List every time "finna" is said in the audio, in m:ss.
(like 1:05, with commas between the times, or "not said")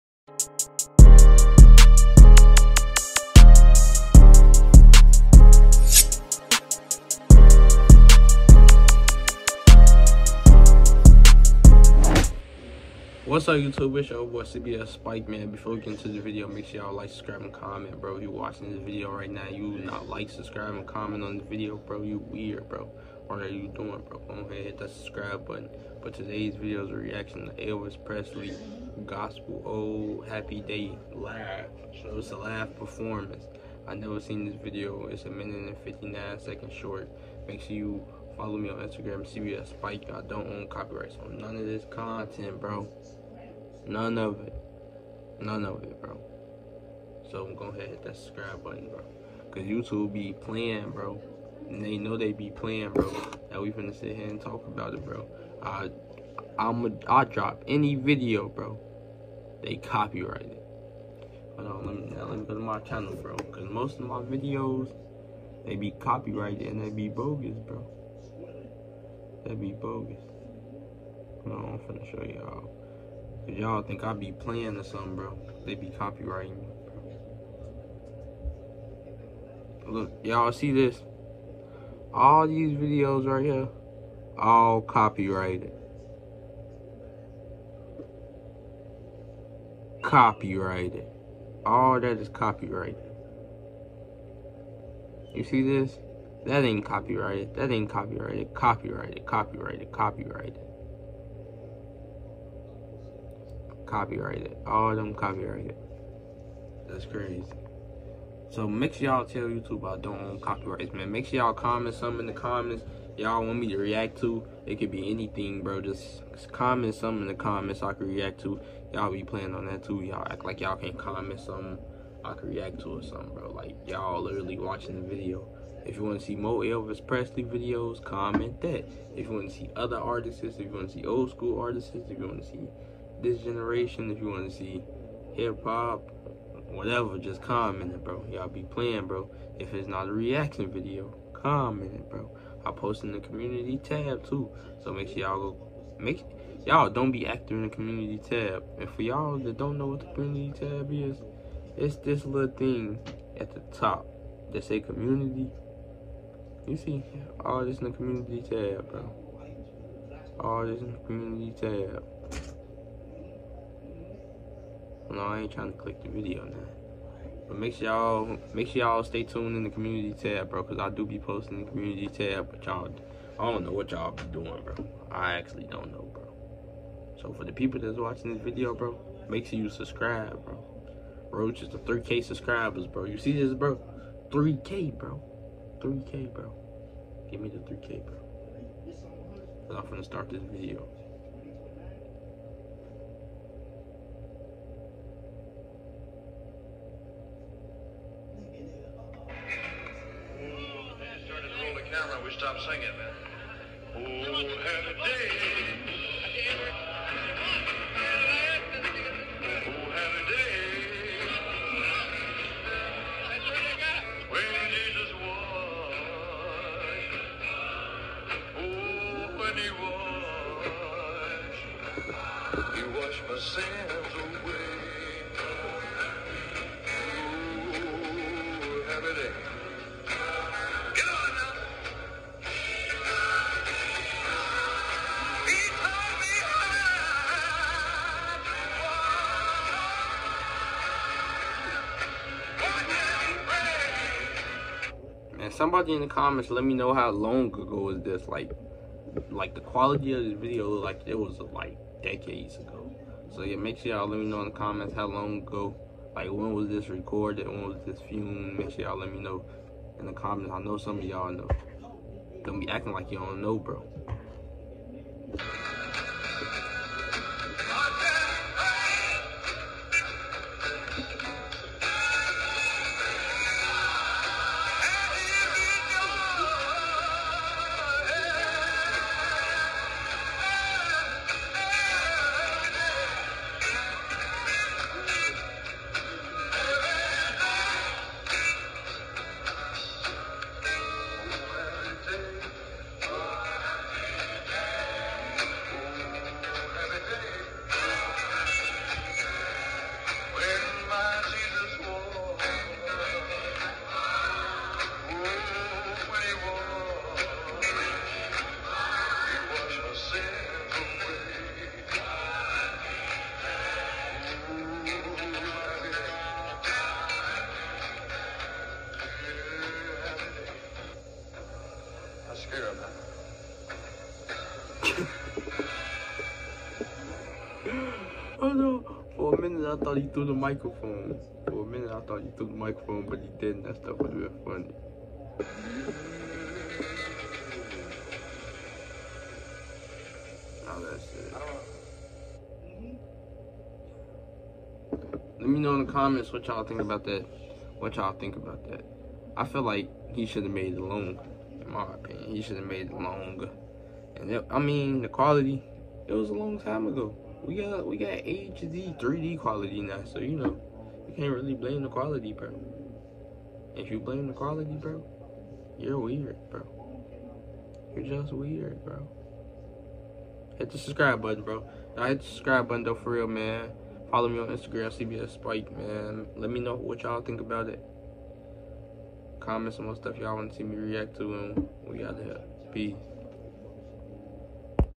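0:53, 1:11, 3:09.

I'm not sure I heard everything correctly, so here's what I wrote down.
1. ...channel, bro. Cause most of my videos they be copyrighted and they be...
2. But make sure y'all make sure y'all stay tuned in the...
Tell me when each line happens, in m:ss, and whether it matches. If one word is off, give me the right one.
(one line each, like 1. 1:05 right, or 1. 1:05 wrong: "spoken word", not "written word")
1. 1:02 right
2. 2:47 right.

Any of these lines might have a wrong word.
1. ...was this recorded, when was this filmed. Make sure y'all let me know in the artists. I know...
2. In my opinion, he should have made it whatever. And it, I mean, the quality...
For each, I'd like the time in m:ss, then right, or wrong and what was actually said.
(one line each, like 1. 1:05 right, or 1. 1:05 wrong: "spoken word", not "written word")
1. 4:16 wrong: "comments", not "artists"
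2. 5:51 wrong: "longer", not "whatever".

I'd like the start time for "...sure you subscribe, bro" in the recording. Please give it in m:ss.
2:59.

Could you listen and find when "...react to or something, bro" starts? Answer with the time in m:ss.
2:02.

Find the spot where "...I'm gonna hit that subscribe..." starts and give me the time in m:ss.
0:47.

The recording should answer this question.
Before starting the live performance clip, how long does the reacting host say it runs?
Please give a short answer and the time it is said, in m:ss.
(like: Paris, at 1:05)
1 minute 59 seconds, at 0:35.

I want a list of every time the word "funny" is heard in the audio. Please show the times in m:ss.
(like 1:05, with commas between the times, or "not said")
5:34.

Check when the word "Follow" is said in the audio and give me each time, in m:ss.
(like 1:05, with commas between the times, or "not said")
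0:38, 6:14.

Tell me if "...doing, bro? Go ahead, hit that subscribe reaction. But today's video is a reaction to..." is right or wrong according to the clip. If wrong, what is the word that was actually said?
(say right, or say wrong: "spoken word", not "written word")
wrong: "button", not "reaction".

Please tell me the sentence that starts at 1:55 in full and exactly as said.
Just comment some in the comments I could react to.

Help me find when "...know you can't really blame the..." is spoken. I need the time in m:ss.
6:00.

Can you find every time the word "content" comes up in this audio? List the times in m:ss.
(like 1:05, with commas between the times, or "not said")
0:41.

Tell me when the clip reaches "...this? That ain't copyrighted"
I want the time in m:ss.
1:35.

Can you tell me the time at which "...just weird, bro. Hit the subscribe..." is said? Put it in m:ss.
6:08.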